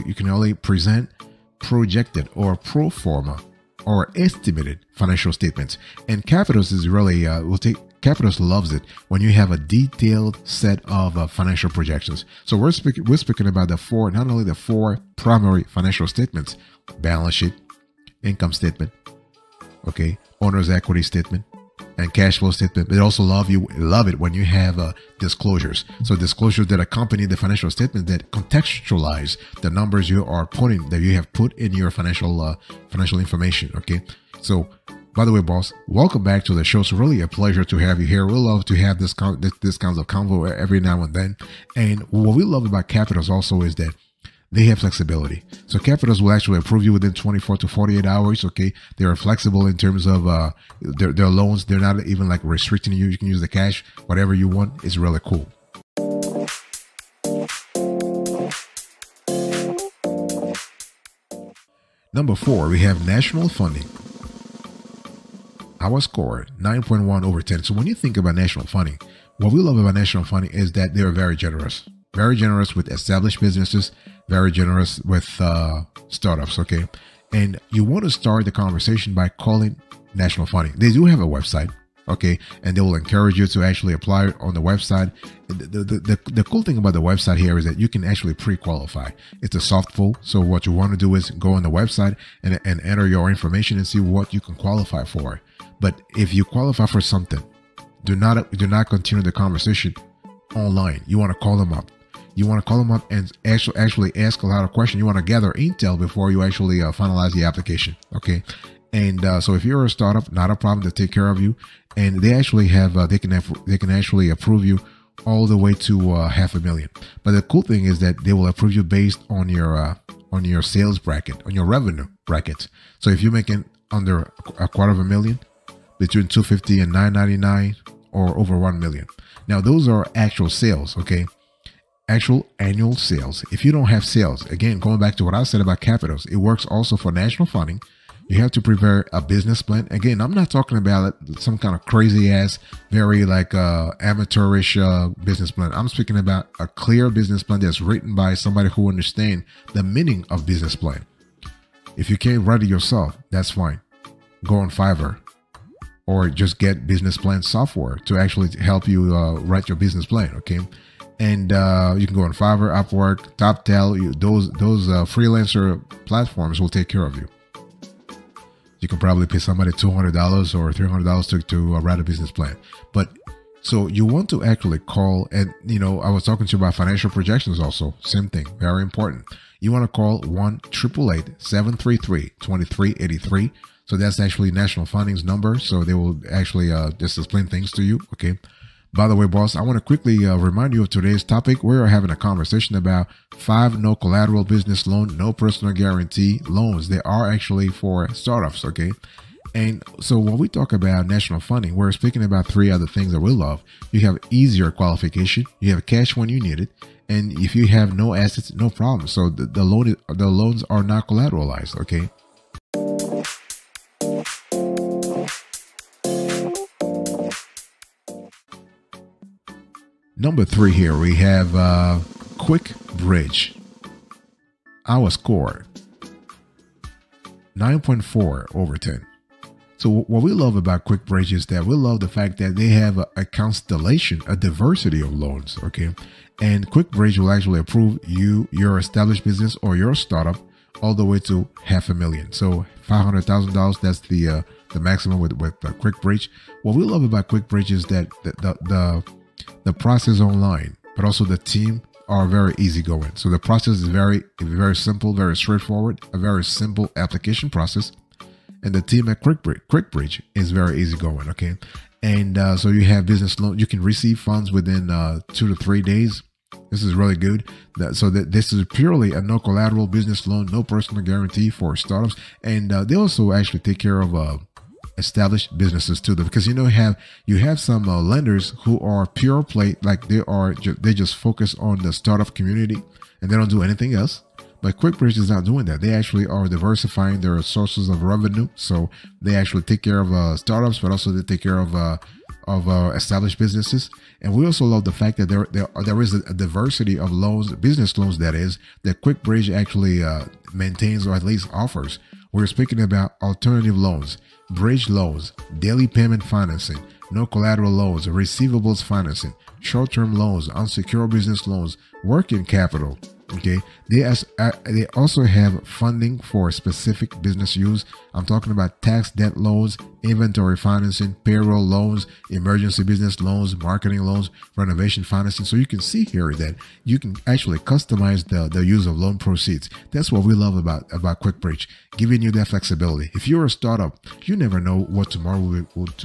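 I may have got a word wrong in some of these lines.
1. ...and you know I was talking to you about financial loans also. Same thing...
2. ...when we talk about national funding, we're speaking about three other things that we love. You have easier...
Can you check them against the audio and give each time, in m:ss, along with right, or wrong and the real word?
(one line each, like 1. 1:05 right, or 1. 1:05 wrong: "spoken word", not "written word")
1. 2:55 wrong: "projections", not "loans"
2. 3:20 right.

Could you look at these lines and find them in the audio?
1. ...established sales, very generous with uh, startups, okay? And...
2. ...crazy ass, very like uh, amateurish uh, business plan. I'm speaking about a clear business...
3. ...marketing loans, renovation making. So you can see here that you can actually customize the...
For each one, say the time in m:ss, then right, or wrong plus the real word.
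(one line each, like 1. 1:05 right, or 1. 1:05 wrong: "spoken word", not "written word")
1. 1:12 wrong: "businesses", not "sales"
2. 2:21 right
3. 5:23 wrong: "financing", not "making".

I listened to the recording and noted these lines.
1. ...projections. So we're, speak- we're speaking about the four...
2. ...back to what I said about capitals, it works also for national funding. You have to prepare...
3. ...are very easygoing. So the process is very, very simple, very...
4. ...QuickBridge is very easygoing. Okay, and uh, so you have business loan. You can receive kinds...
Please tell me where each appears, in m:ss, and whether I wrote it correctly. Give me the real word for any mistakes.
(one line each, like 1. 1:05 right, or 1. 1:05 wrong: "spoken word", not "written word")
1. 0:11 right
2. 2:14 right
3. 4:12 right
4. 4:19 wrong: "funds", not "kinds".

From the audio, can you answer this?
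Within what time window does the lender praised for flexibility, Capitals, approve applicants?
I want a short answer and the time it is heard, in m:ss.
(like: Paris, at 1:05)
24 to 48 hours, at 0:47.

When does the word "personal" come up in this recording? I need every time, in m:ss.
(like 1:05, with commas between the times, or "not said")
3:15, 4:30.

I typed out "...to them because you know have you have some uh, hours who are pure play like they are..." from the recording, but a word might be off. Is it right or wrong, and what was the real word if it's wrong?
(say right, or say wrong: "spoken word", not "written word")
wrong: "lenders", not "hours".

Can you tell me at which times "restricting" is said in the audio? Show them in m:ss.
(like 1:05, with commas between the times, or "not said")
0:52.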